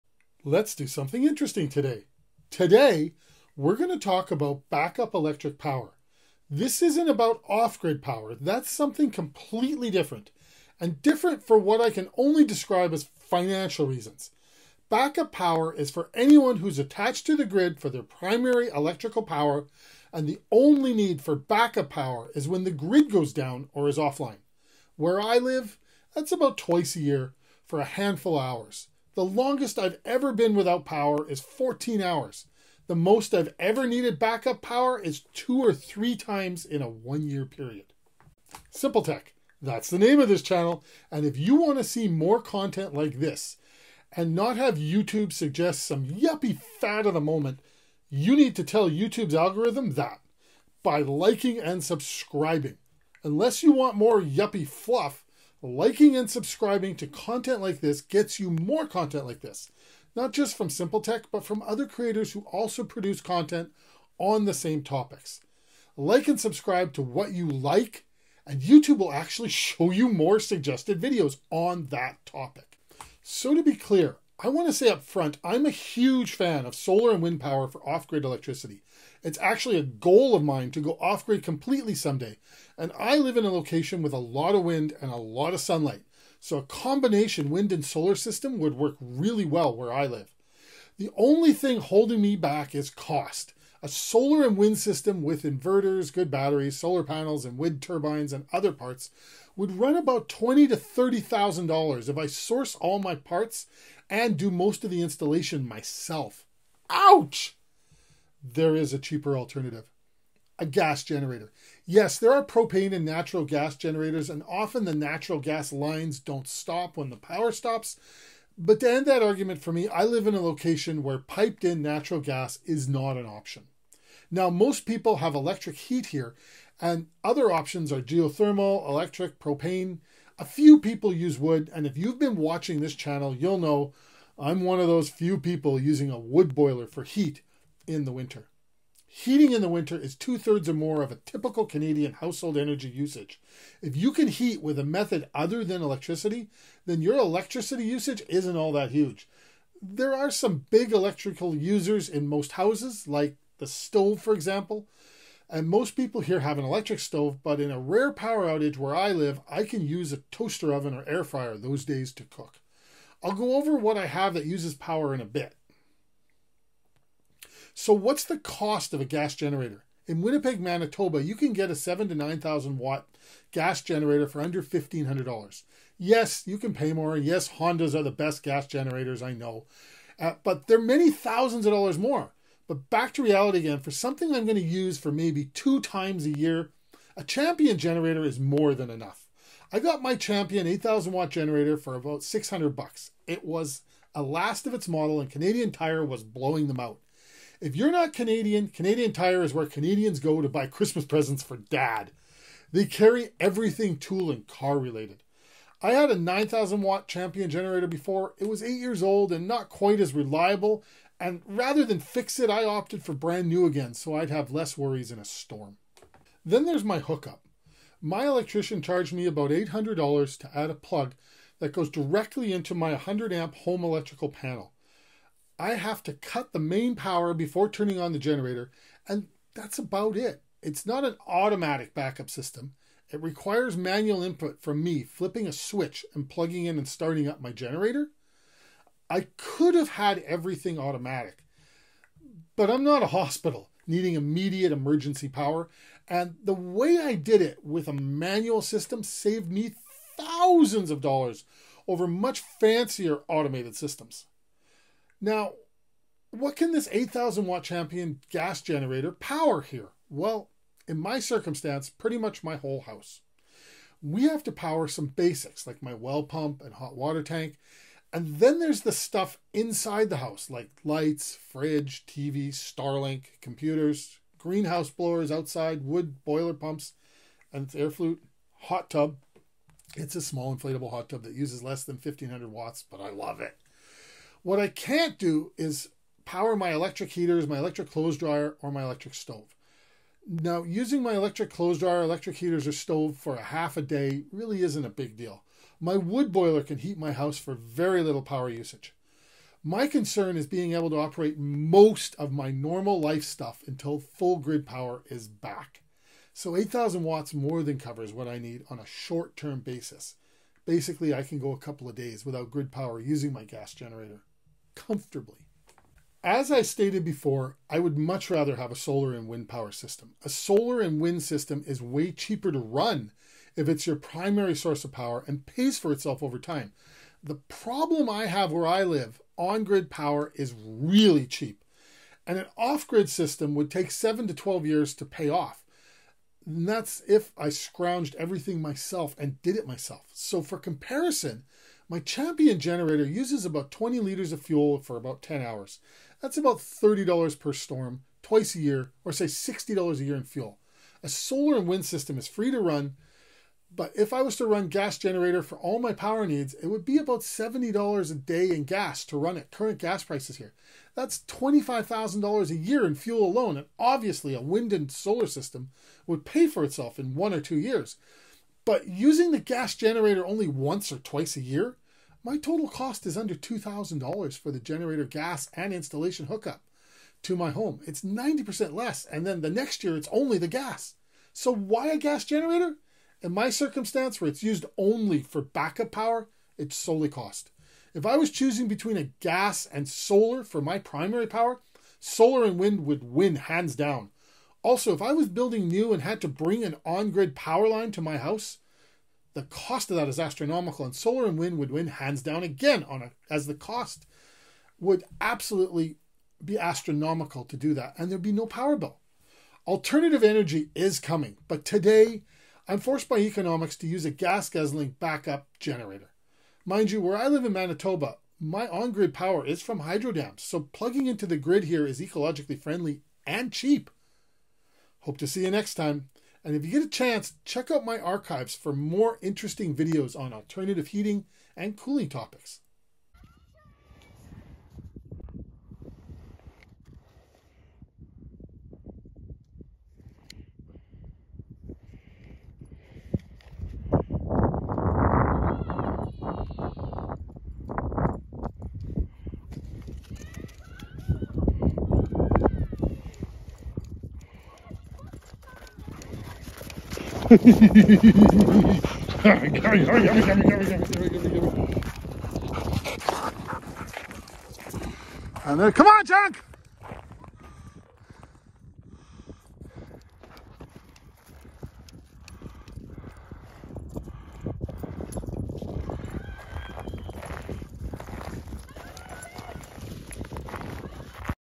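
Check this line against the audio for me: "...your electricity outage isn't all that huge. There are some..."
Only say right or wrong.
wrong.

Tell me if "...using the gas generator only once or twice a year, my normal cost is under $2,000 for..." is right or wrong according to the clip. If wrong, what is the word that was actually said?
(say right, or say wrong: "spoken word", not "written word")
wrong: "total", not "normal".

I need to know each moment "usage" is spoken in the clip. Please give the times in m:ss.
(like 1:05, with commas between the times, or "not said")
2:22, 2:27, 4:58.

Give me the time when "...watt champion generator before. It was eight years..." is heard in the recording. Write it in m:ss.
3:26.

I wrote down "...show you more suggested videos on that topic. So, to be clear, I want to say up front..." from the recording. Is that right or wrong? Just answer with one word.
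right.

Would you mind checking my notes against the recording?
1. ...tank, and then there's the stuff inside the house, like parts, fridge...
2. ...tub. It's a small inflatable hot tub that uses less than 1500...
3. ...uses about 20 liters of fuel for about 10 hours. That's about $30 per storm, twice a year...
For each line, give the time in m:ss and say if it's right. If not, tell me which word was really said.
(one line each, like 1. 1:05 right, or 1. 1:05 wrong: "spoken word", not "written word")
1. 4:27 wrong: "lights", not "parts"
2. 4:38 right
3. 5:43 right.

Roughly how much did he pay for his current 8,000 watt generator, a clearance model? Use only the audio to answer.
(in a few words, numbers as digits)
$600.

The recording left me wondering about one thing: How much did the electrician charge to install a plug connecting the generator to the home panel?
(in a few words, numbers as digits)
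$800.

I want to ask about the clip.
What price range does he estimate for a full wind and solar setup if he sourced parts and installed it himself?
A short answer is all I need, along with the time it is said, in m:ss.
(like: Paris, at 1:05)
$20,000 to $30,000, at 1:40.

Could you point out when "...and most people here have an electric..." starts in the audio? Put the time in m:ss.
2:35.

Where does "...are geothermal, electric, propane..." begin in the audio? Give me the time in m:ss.
2:07.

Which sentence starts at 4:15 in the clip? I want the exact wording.
Now, what can this 8,000 watt champion gas generator power here?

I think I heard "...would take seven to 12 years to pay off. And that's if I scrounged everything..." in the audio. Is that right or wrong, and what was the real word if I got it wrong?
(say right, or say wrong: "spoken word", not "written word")
right.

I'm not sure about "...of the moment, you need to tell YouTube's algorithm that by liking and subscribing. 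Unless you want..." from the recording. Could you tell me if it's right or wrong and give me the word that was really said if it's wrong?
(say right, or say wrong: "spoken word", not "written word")
right.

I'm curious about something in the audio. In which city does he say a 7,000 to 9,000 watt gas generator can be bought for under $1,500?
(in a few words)
Winnipeg.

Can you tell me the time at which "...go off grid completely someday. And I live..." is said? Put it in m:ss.
1:20.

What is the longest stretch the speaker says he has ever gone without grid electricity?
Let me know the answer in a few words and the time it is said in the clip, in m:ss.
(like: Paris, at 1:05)
14 hours, at 0:31.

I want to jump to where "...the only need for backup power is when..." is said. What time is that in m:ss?
0:20.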